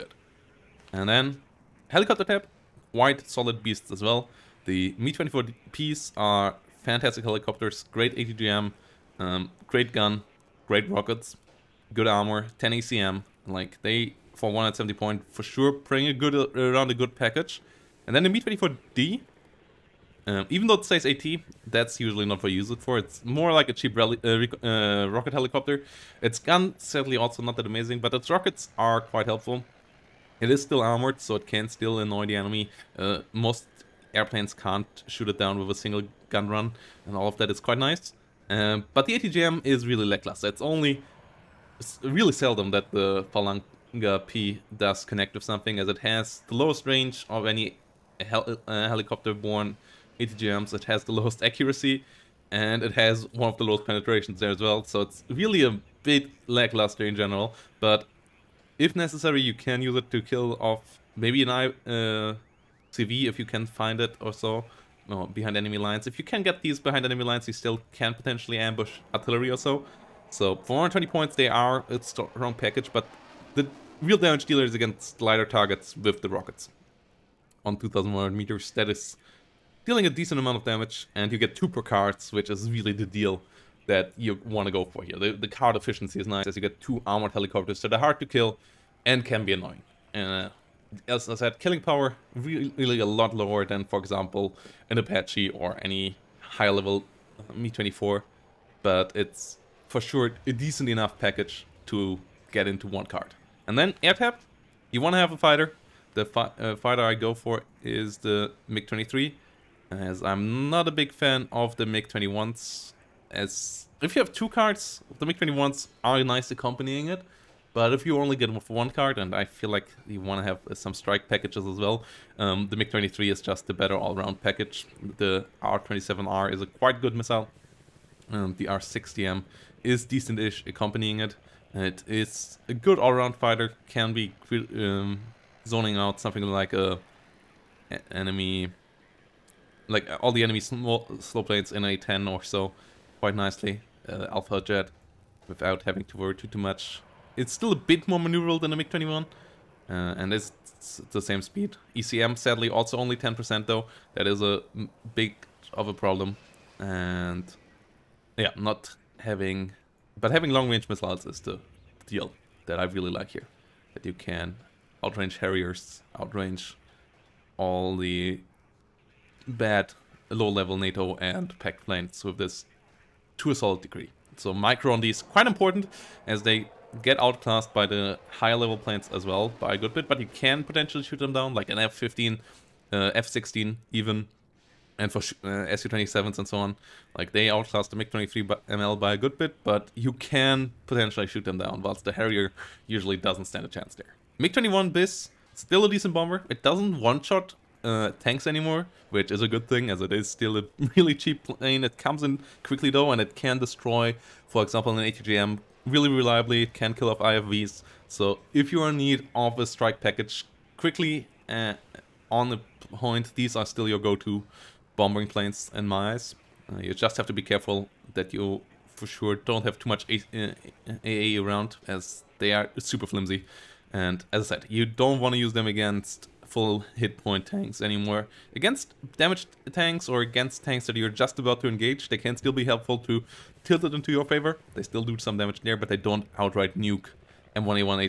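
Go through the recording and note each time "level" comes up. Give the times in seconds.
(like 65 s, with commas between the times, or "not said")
96 s, 170 s, 178 s.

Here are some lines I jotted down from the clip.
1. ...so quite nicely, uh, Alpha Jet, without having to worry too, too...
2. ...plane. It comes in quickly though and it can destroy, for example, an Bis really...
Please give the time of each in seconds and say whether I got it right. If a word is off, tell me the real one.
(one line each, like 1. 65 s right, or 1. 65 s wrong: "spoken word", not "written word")
1. 142 s right
2. 201 s wrong: "ATGM", not "Bis".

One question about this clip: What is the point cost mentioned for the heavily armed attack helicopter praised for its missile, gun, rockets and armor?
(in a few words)
170.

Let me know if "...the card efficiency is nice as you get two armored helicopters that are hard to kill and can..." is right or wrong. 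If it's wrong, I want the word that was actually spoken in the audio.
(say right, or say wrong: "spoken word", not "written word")
right.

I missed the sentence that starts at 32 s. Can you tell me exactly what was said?
Uh, most airplanes can't shoot it down with a single gun run, and all of that is quite nice.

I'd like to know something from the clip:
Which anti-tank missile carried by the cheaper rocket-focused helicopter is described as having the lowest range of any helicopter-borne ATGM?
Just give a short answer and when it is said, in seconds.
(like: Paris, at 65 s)
Falanga P, at 43 s.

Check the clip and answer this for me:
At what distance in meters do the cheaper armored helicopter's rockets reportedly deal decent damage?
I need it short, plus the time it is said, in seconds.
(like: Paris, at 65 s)
2,100, at 77 s.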